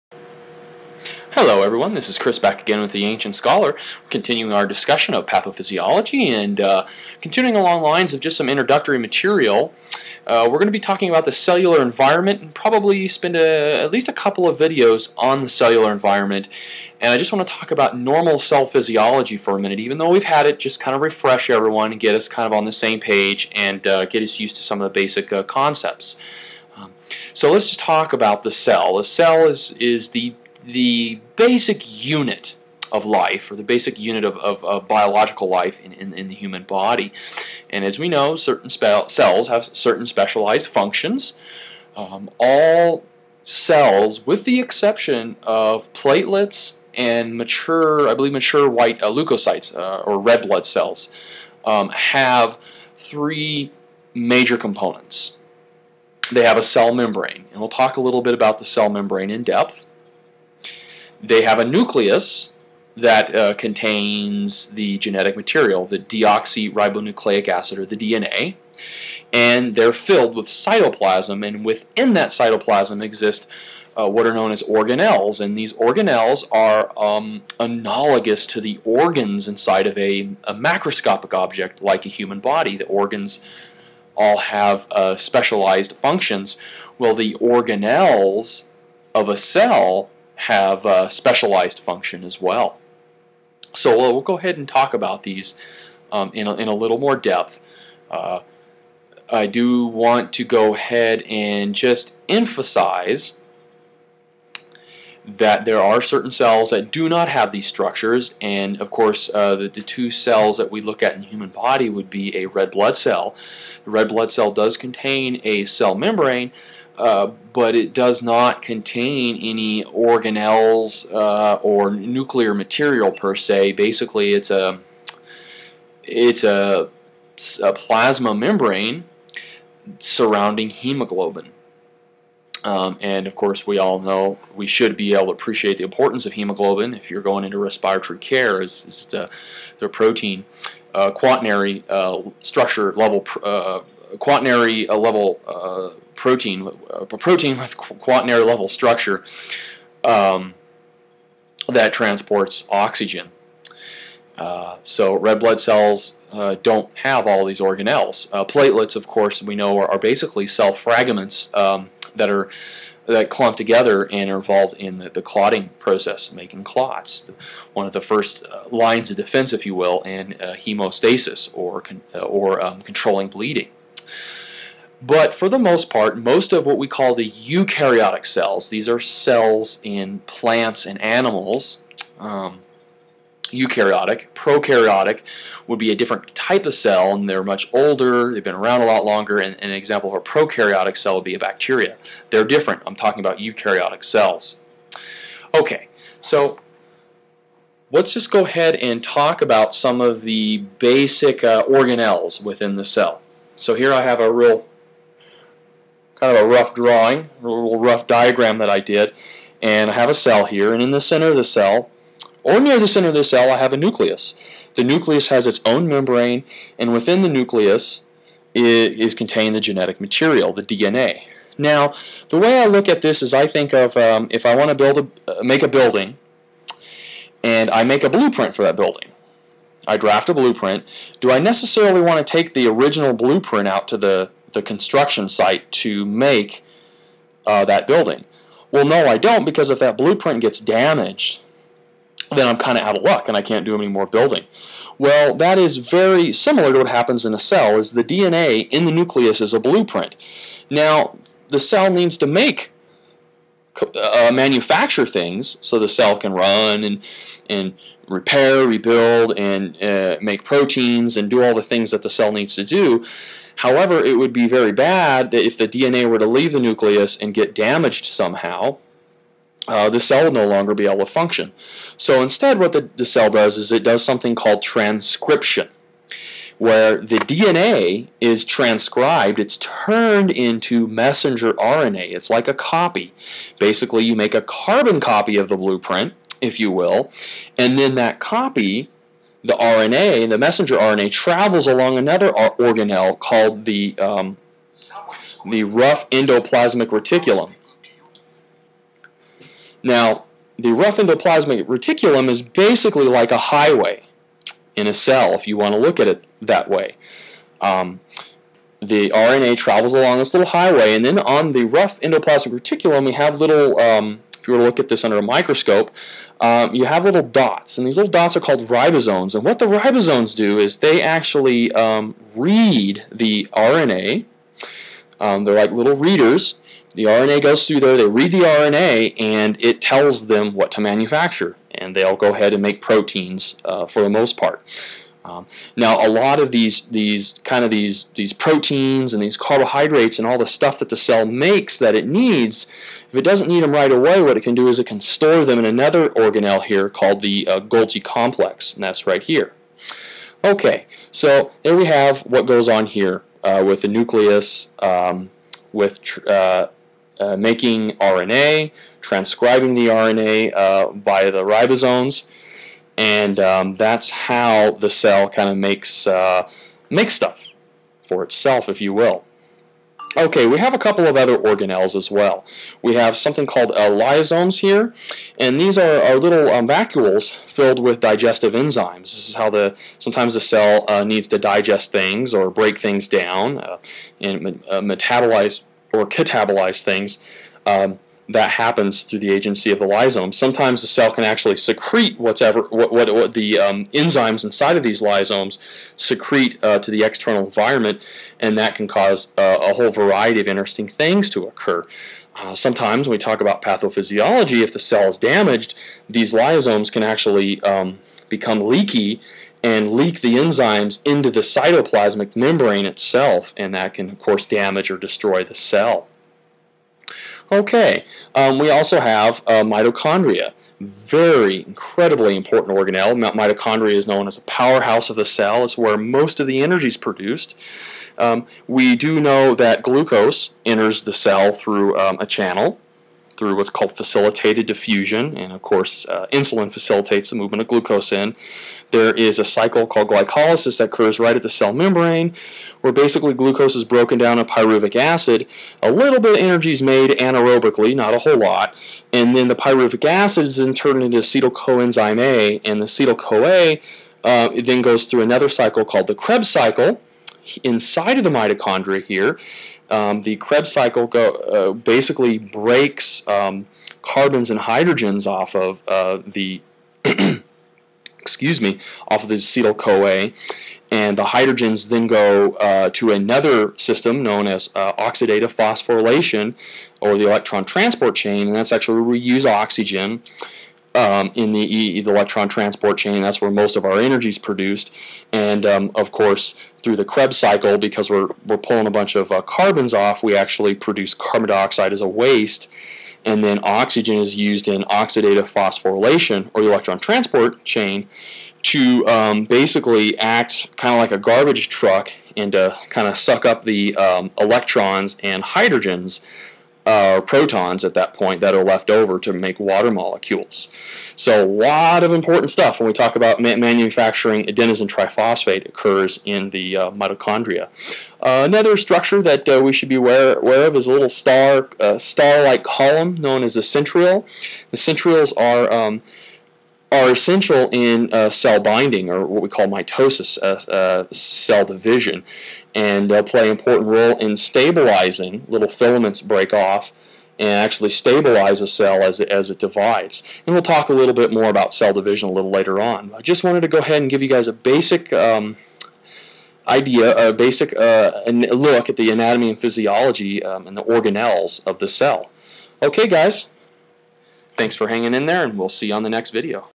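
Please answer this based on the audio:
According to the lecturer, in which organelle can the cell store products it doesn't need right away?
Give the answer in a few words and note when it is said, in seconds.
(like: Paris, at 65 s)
Golgi complex, at 347 s.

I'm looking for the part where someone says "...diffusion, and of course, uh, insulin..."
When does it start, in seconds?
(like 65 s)
434 s.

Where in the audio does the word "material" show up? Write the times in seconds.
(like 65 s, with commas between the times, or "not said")
8 s, 65 s, 122 s, 220 s.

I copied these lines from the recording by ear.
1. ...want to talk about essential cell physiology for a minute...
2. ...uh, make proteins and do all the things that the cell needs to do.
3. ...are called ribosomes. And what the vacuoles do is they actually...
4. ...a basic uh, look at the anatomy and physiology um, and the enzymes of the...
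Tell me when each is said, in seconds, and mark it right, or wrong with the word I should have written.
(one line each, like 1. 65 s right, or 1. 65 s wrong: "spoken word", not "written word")
1. 17 s wrong: "normal", not "essential"
2. 259 s right
3. 318 s wrong: "ribosomes", not "vacuoles"
4. 547 s wrong: "organelles", not "enzymes".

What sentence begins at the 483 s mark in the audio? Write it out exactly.
That's where most of our energy is produced.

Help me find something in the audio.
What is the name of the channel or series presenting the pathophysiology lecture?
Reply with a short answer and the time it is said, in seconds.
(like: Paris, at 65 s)
The Ancient Scholar, at 3 s.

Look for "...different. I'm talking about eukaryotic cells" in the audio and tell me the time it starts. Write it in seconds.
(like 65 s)
192 s.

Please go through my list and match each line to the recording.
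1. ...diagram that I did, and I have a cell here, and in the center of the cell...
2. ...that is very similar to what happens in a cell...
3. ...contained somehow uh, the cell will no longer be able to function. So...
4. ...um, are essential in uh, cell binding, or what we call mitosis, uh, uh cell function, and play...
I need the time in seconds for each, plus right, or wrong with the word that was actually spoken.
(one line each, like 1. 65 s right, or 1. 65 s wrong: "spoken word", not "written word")
1. 208 s right
2. 245 s right
3. 267 s wrong: "damaged", not "contained"
4. 525 s wrong: "division", not "function".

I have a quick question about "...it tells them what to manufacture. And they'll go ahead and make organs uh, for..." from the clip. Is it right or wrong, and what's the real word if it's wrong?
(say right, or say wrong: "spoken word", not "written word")
wrong: "proteins", not "organs".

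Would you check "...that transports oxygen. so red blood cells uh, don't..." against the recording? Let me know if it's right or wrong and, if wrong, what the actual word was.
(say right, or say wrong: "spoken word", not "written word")
right.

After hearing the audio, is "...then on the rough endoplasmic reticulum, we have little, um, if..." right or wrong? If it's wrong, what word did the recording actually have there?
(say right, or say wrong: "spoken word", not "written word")
right.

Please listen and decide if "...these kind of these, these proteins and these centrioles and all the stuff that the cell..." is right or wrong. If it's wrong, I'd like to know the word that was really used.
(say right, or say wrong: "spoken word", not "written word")
wrong: "carbohydrates", not "centrioles".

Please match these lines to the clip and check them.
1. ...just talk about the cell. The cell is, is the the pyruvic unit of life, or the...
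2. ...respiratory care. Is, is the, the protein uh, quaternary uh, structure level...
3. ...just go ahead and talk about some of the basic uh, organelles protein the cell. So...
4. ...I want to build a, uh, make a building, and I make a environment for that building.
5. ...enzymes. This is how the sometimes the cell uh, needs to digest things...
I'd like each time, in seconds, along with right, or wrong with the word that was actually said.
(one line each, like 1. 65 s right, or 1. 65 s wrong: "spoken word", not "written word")
1. 27 s wrong: "basic", not "pyruvic"
2. 137 s right
3. 198 s wrong: "within", not "protein"
4. 224 s wrong: "blueprint", not "environment"
5. 378 s right.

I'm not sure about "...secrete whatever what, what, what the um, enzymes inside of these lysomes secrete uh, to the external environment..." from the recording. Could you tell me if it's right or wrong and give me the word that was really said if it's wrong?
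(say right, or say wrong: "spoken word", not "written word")
right.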